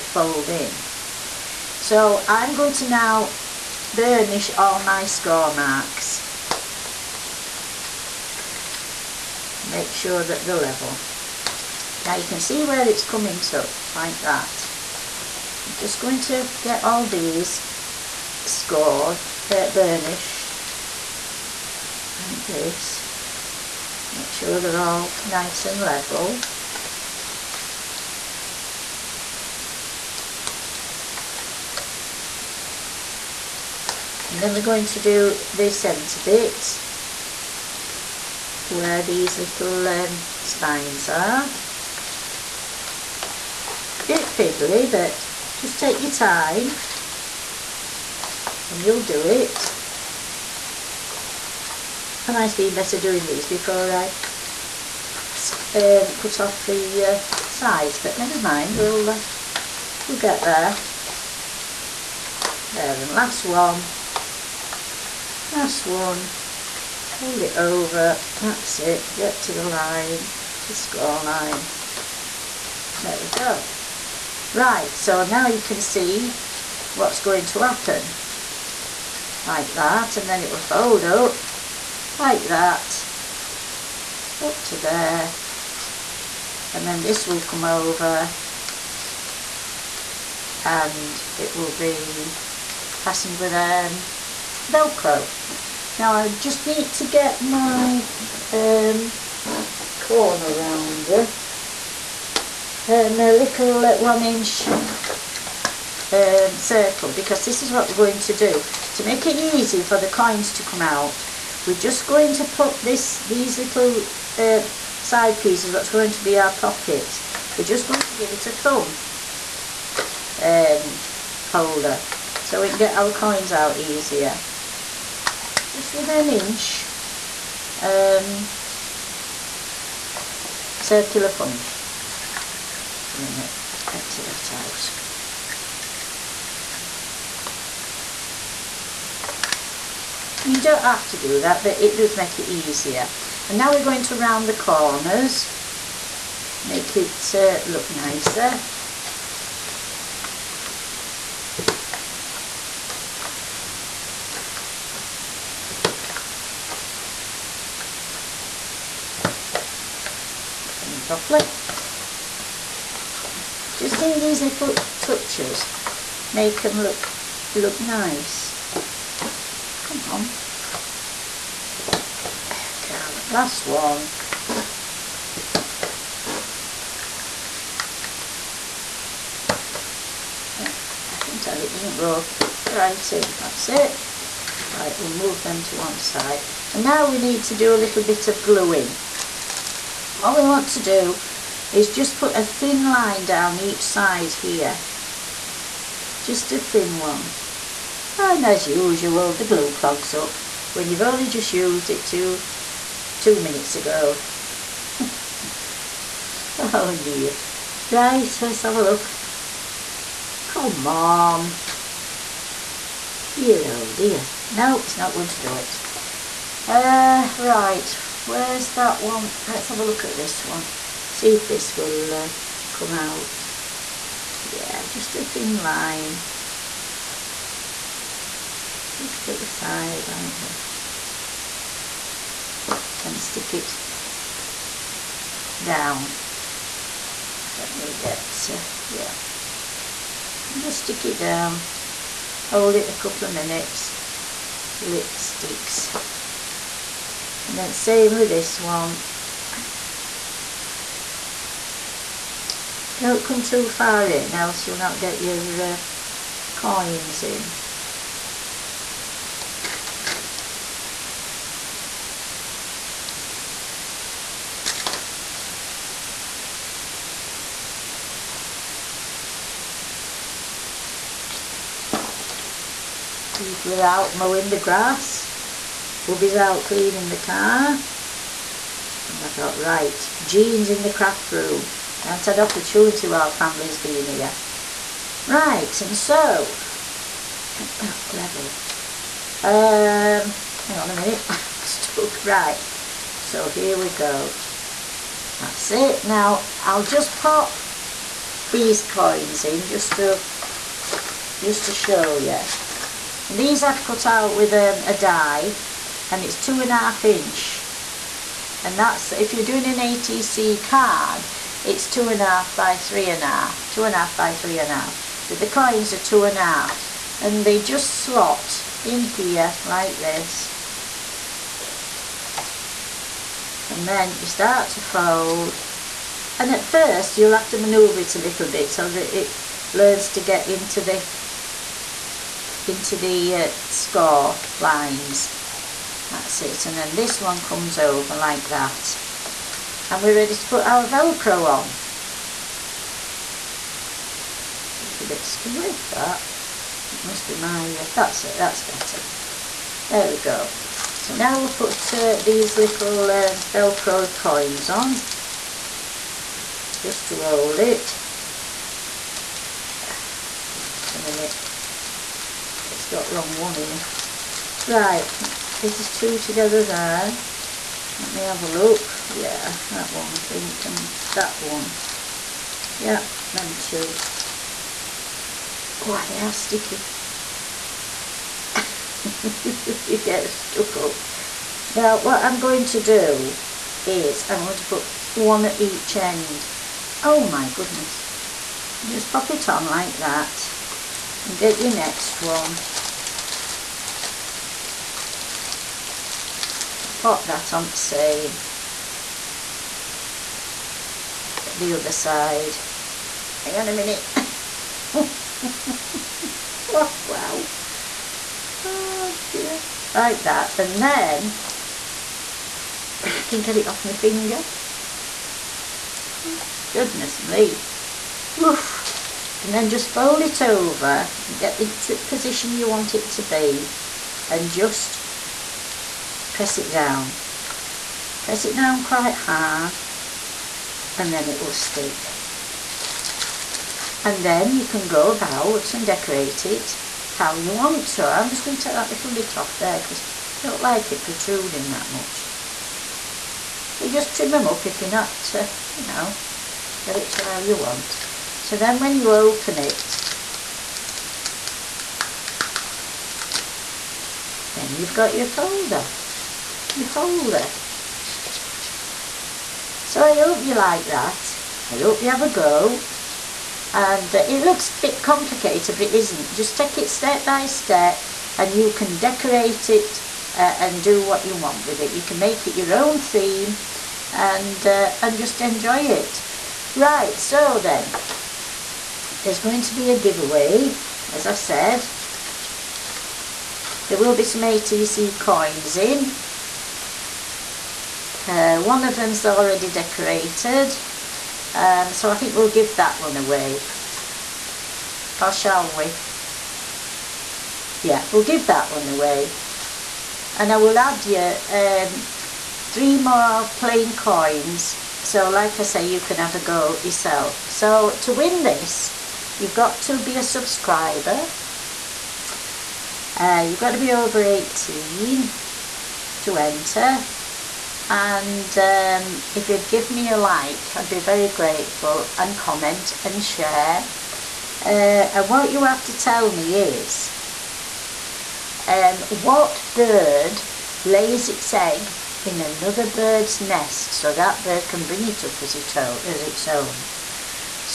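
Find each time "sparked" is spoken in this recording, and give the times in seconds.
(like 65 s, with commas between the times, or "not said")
not said.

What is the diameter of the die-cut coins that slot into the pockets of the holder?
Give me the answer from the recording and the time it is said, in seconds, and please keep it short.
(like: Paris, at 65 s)
2.5 inches, at 306 s.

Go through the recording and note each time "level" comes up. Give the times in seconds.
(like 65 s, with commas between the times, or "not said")
10 s, 25 s, 288 s.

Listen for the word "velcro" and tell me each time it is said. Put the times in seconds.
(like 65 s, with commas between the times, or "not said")
94 s, 340 s, 353 s.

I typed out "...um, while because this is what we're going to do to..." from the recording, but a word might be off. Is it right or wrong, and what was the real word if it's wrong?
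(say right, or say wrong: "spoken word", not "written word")
wrong: "circle", not "while".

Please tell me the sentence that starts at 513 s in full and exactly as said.
Uh, you've got to be over 18 to enter.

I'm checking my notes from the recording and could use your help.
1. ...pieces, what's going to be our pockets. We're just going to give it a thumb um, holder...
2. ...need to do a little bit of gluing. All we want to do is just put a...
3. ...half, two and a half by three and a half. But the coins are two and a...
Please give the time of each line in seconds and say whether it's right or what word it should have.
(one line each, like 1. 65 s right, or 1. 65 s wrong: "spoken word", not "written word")
1. 115 s right
2. 187 s right
3. 313 s right.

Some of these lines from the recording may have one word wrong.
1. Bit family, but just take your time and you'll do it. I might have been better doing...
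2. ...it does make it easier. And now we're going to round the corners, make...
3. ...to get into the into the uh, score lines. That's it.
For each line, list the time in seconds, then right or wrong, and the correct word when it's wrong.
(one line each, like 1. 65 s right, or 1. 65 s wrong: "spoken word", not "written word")
1. 44 s wrong: "fiddly", not "family"
2. 141 s right
3. 330 s right.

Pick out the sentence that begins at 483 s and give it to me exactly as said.
There will be some ATC coins in.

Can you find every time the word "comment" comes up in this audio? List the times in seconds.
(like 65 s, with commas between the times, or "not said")
522 s.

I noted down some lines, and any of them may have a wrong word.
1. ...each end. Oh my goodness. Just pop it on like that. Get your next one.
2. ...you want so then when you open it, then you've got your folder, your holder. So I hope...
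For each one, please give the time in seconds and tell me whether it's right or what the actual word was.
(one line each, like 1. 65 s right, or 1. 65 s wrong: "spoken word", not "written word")
1. 385 s right
2. 447 s right.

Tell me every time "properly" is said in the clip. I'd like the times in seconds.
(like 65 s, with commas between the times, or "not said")
161 s.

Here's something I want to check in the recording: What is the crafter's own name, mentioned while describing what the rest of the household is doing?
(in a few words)
Jean.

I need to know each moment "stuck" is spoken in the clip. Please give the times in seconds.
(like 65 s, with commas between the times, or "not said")
291 s, 380 s.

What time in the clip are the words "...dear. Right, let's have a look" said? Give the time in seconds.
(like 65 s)
207 s.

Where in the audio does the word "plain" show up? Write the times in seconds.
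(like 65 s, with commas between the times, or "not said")
503 s.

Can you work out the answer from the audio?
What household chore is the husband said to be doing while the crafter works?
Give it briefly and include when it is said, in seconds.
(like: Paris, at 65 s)
cleaning the car, at 276 s.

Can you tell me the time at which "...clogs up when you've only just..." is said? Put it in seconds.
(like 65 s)
199 s.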